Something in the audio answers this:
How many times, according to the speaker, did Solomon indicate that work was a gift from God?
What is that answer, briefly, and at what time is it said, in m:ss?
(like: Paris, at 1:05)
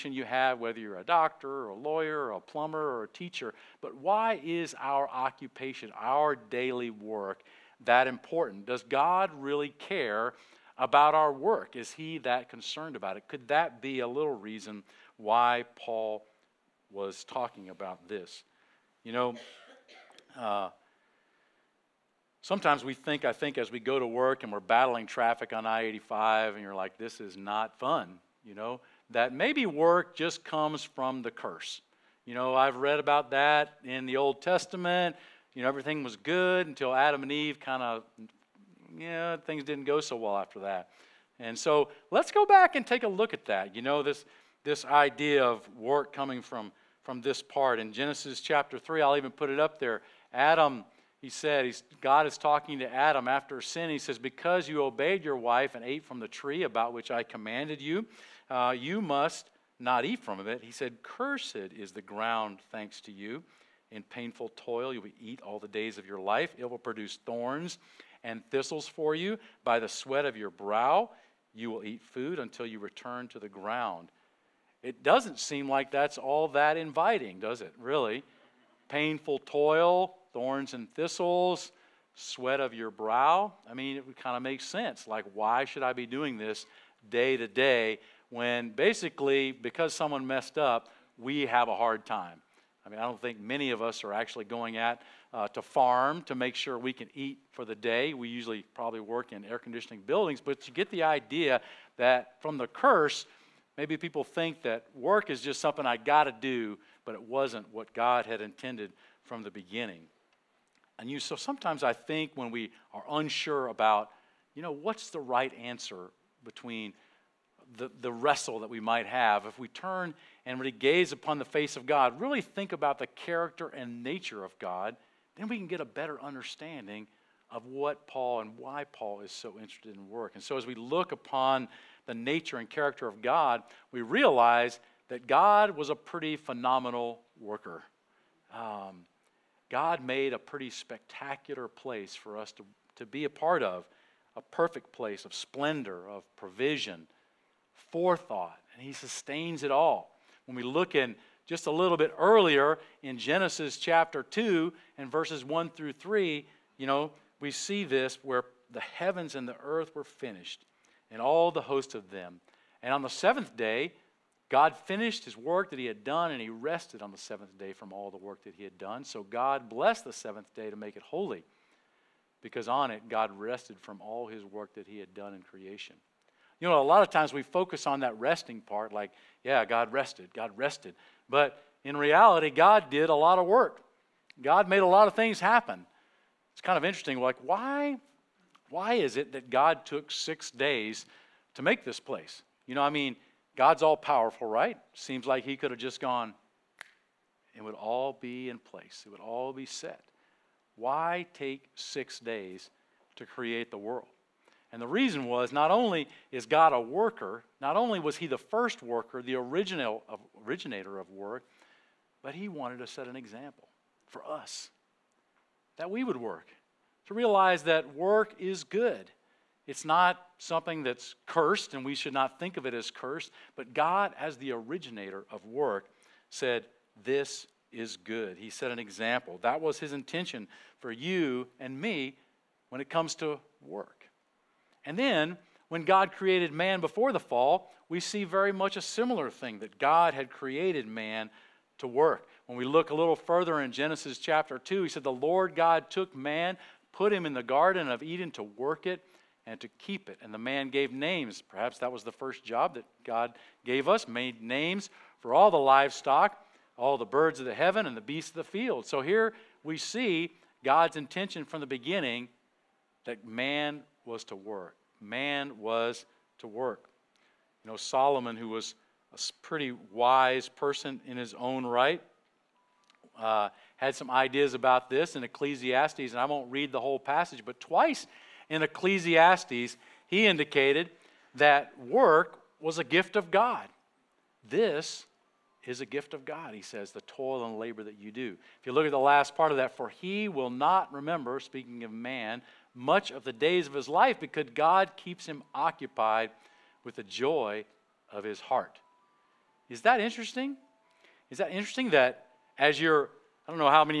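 2, at 4:37.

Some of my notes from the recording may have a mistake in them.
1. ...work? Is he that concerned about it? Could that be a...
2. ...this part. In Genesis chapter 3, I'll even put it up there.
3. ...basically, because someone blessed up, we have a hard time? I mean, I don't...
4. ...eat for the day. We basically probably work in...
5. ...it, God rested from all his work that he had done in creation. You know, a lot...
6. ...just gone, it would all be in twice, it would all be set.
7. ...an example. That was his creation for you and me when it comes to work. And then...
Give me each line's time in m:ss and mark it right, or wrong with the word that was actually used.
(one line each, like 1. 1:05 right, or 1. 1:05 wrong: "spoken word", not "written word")
1. 0:11 right
2. 0:47 right
3. 1:28 wrong: "messed", not "blessed"
4. 1:37 wrong: "usually", not "basically"
5. 2:52 right
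6. 3:15 wrong: "place", not "twice"
7. 3:48 wrong: "intention", not "creation".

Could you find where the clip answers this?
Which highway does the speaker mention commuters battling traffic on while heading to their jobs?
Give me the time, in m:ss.
0:25.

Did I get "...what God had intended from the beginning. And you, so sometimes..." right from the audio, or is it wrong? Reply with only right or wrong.
right.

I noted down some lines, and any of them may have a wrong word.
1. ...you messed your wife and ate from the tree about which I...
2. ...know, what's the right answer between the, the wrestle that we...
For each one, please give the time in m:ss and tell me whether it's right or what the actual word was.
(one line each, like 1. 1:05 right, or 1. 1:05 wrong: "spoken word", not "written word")
1. 0:54 wrong: "obeyed", not "messed"
2. 1:54 right.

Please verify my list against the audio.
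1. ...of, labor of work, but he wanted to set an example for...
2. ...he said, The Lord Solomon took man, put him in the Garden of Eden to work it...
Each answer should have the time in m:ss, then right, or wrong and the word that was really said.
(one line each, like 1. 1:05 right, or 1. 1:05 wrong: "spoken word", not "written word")
1. 3:30 wrong: "originator", not "labor"
2. 4:04 wrong: "God", not "Solomon".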